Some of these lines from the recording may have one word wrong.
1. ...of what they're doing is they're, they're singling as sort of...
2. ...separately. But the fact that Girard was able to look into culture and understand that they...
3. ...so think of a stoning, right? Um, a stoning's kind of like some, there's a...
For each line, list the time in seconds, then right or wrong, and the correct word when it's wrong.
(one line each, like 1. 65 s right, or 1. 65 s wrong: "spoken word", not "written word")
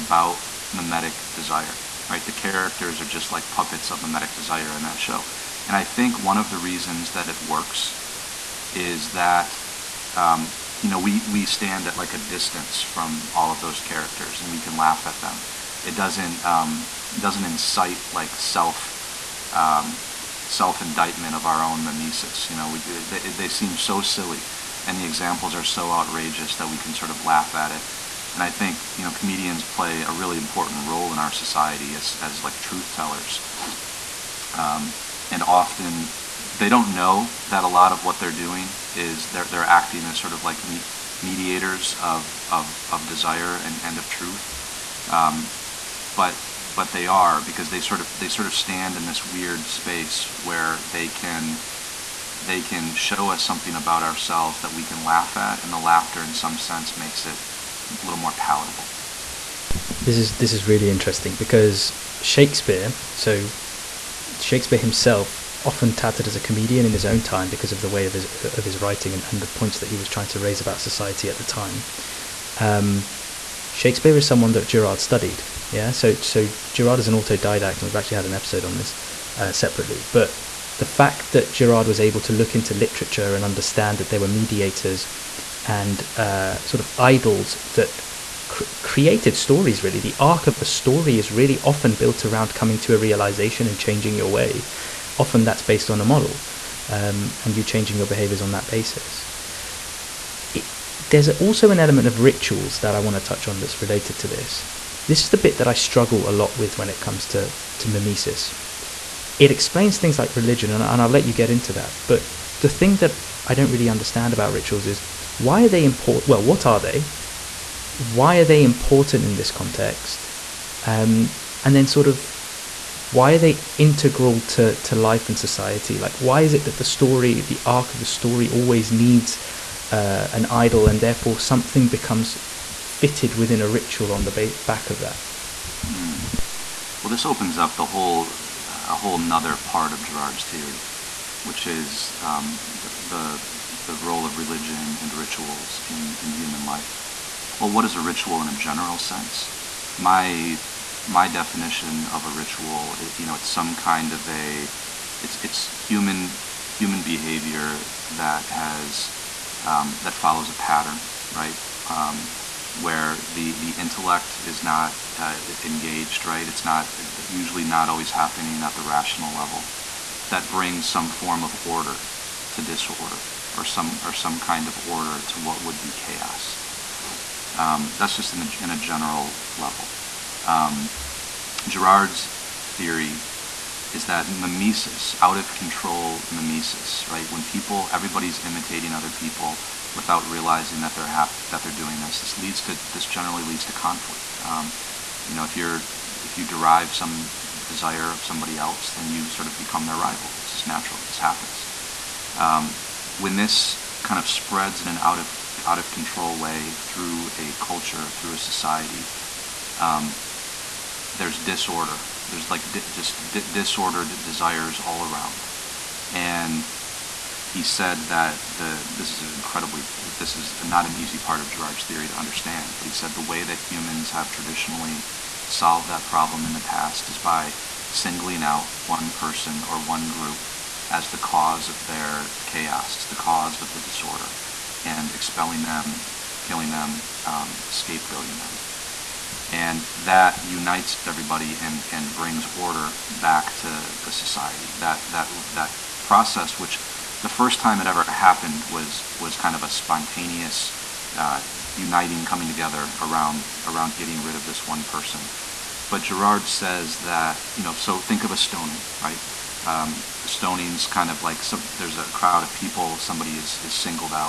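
1. 37 s wrong: "acting", not "singling"
2. 79 s wrong: "literature", not "culture"
3. 257 s right.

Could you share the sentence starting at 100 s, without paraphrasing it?
It, there's also an element of rituals that I want to touch on that's related to this.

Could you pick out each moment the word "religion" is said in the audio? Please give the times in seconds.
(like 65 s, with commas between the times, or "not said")
110 s, 144 s.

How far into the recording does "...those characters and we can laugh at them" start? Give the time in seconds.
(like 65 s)
13 s.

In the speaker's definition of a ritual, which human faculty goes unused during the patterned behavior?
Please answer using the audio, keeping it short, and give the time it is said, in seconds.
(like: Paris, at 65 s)
The intellect, at 163 s.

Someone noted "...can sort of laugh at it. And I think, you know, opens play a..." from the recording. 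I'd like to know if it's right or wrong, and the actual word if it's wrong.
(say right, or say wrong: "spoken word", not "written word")
wrong: "comedians", not "opens".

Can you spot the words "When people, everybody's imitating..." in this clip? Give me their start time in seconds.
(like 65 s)
187 s.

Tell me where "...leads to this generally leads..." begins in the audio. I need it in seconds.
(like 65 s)
192 s.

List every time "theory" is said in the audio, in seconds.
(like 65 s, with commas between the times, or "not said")
140 s, 182 s, 221 s.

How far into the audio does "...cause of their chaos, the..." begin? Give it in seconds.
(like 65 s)
231 s.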